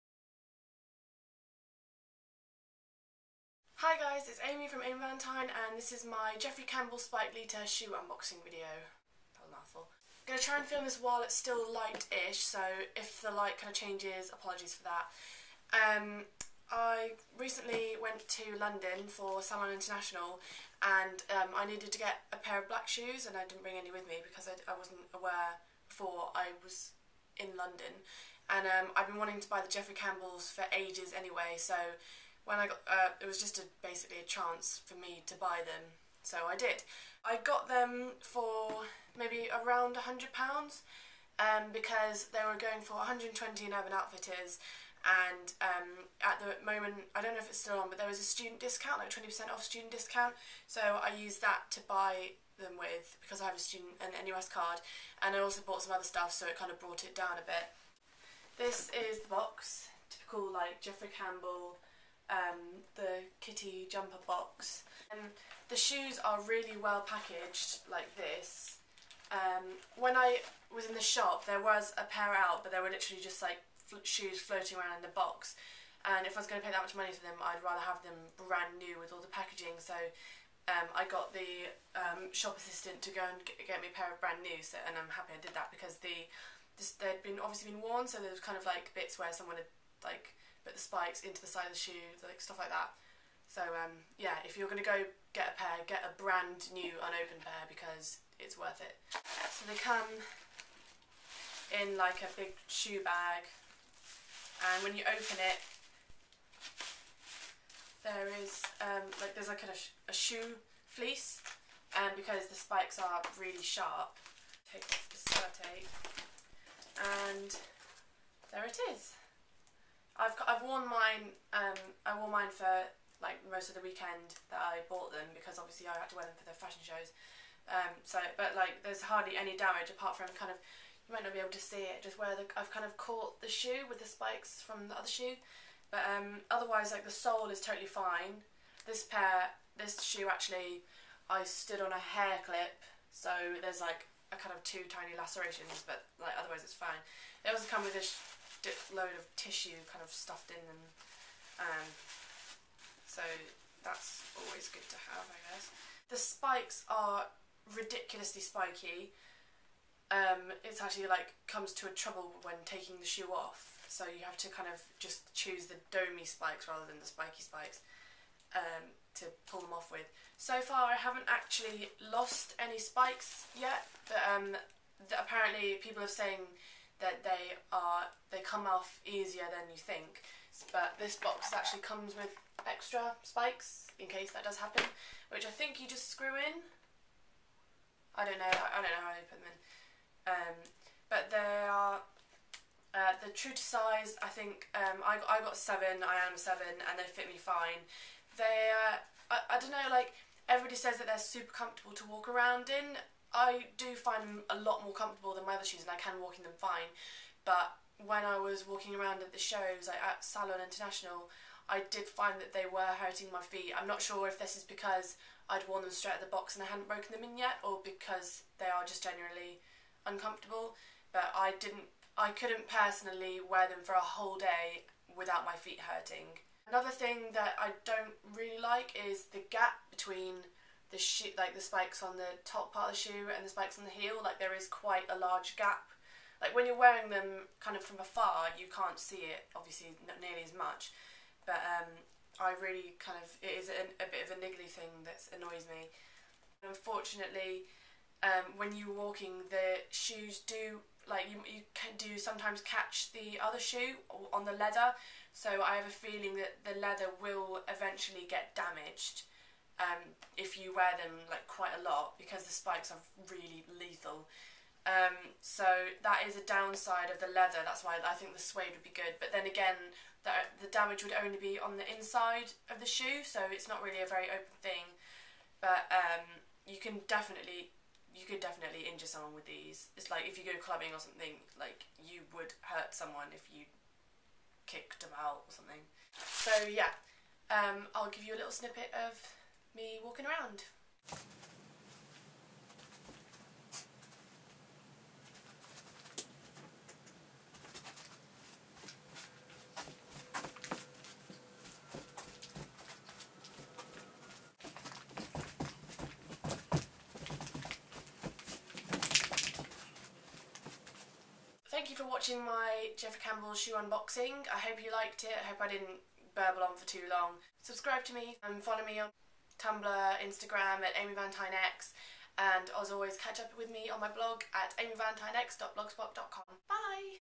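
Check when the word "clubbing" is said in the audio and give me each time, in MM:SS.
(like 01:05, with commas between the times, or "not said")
04:40.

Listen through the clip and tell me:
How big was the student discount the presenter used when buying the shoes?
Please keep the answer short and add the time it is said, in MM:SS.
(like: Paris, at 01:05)
20%, at 00:49.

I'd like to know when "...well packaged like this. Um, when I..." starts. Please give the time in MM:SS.
01:06.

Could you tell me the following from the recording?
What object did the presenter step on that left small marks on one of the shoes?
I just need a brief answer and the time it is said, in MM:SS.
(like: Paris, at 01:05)
a hair clip, at 02:22.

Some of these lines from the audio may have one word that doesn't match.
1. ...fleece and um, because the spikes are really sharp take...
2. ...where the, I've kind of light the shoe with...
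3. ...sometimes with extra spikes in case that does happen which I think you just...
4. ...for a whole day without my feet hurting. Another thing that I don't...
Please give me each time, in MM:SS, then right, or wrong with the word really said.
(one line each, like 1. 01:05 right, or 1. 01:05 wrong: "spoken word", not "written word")
1. 01:50 right
2. 02:12 wrong: "caught", not "light"
3. 03:01 wrong: "comes", not "sometimes"
4. 03:43 right.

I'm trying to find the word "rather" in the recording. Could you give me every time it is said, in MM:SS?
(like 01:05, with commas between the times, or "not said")
01:17, 02:46.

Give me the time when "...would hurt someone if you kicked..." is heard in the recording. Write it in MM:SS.
04:42.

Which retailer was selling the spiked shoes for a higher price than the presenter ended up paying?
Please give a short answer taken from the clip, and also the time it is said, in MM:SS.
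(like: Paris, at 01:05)
Urban Outfitters, at 00:43.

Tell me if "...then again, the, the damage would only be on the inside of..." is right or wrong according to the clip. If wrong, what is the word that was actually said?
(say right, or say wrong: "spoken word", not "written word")
right.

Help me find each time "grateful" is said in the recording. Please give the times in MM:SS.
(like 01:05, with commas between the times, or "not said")
not said.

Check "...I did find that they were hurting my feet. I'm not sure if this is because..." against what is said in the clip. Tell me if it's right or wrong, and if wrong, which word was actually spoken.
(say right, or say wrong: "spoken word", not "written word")
right.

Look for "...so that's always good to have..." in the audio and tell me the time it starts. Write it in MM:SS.
02:33.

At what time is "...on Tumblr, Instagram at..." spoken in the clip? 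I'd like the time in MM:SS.
05:18.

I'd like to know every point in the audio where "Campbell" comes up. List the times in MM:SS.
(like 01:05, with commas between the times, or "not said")
00:06, 00:29, 01:01, 05:13.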